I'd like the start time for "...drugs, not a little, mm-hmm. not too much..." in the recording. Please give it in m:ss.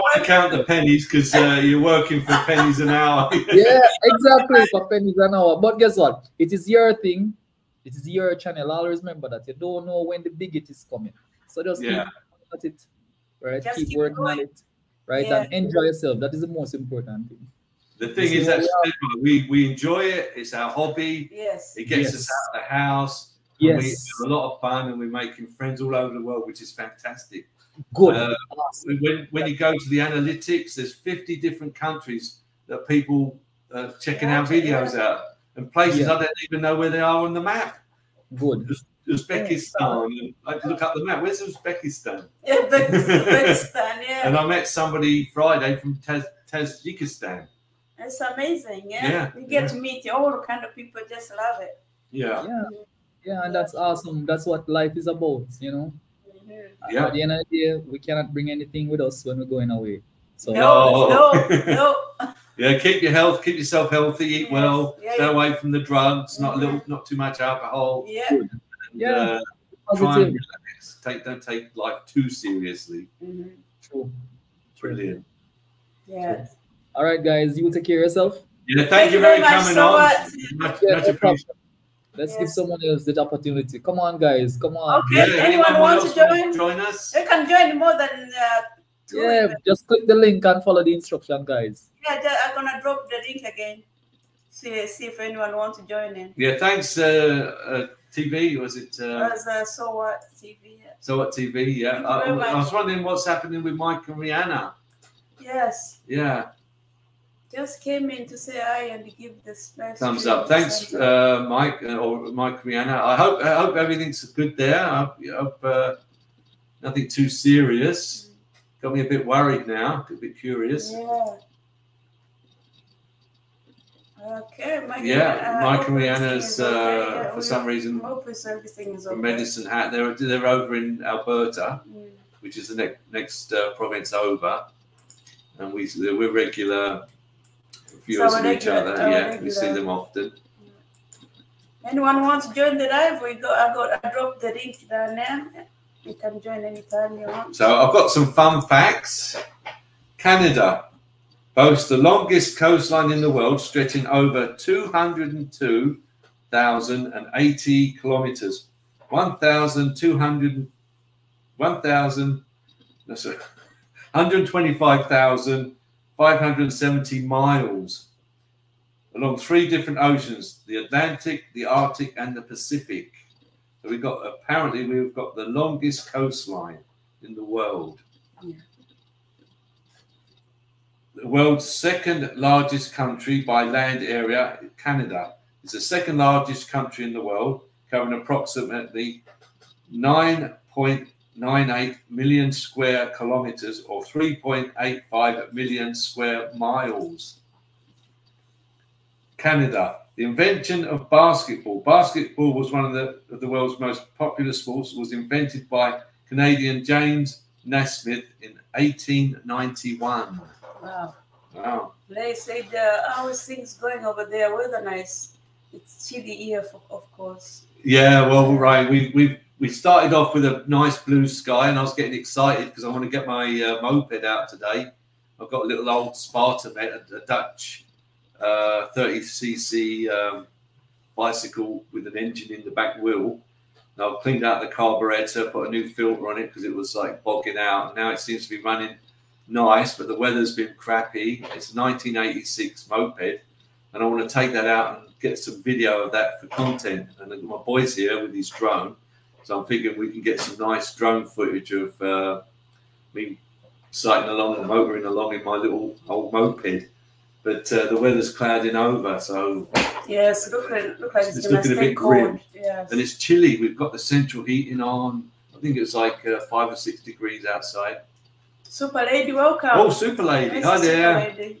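1:05.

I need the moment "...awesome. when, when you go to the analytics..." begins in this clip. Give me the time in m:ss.
0:28.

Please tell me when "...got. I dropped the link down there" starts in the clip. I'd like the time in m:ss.
2:23.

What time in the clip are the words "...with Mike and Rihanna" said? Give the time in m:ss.
1:43.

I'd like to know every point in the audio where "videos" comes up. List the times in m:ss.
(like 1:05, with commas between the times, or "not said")
0:34, 4:05.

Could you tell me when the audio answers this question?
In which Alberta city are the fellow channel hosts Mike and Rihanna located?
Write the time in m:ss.
2:09.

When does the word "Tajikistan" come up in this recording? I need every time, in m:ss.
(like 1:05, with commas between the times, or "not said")
0:46.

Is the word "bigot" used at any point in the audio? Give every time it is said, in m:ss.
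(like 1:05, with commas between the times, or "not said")
0:10.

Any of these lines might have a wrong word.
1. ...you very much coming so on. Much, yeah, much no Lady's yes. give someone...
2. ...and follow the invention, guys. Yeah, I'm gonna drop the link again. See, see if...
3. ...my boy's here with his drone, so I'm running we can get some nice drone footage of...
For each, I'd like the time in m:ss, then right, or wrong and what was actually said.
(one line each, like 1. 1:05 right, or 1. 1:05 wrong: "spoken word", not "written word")
1. 1:19 wrong: "Let", not "Lady"
2. 1:30 wrong: "instruction", not "invention"
3. 4:07 wrong: "thinking", not "running".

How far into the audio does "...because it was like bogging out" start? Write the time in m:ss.
3:56.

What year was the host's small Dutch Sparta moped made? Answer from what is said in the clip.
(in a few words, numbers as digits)
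1986.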